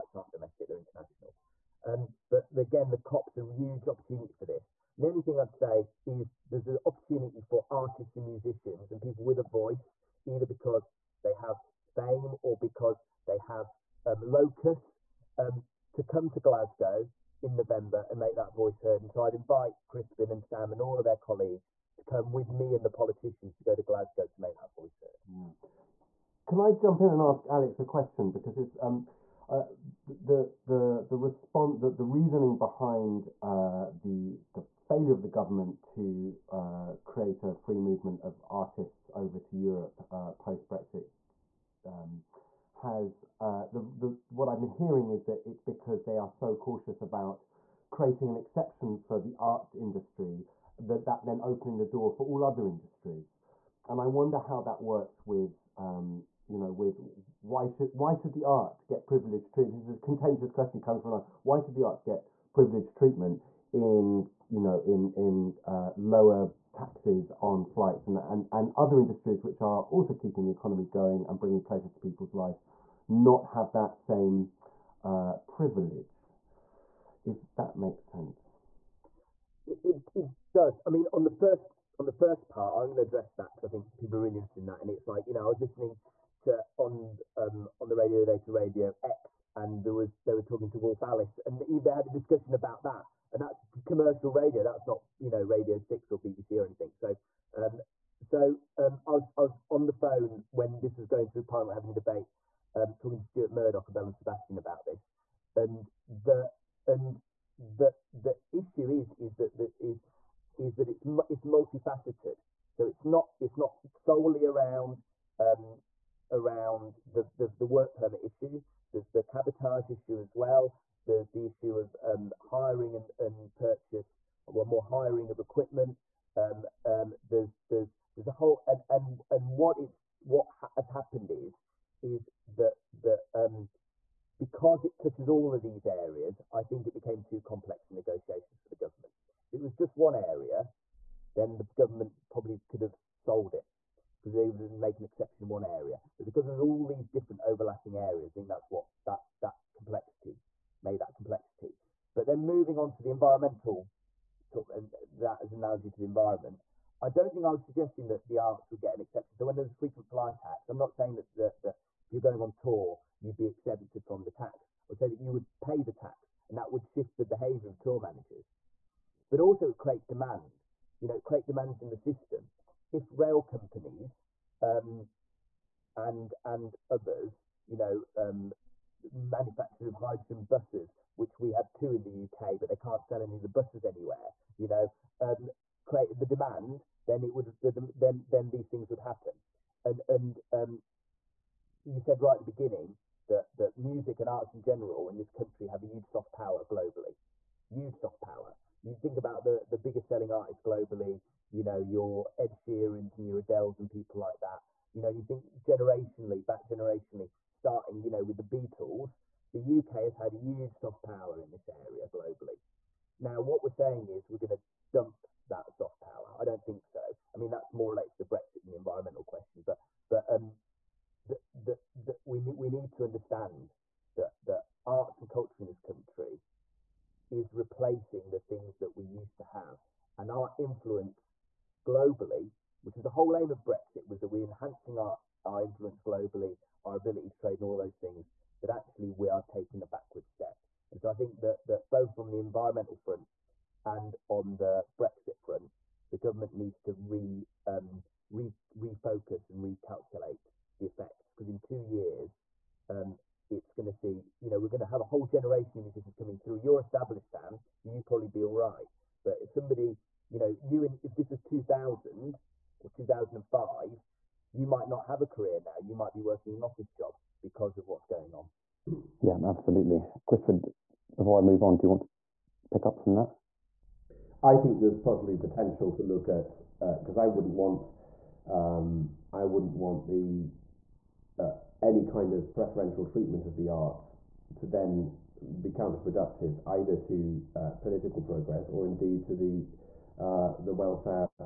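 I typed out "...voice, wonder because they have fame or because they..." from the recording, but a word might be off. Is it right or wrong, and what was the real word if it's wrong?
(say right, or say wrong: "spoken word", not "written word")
wrong: "either", not "wonder".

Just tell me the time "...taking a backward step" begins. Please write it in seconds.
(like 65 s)
239 s.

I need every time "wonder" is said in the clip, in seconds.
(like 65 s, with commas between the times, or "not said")
54 s.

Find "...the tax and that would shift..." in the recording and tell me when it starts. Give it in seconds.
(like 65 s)
165 s.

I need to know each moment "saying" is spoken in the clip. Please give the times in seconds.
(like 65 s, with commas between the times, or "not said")
160 s, 213 s.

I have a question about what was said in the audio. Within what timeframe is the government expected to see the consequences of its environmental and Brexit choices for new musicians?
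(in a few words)
2 years.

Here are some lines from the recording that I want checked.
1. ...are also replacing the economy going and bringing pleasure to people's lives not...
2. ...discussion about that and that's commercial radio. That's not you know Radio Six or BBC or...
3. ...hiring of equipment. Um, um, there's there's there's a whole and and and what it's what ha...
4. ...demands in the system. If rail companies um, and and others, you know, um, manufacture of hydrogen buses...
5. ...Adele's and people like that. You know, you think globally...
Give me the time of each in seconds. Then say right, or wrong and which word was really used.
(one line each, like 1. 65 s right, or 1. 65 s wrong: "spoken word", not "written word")
1. 69 s wrong: "keeping", not "replacing"
2. 92 s right
3. 124 s right
4. 171 s right
5. 203 s wrong: "generationally", not "globally".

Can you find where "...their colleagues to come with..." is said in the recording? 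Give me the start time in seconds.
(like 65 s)
21 s.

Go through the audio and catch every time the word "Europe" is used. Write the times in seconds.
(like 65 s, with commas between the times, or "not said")
39 s.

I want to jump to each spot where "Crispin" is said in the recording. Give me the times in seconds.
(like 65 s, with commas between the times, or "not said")
19 s.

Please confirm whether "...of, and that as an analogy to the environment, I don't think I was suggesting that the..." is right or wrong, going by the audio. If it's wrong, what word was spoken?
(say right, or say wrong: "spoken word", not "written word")
right.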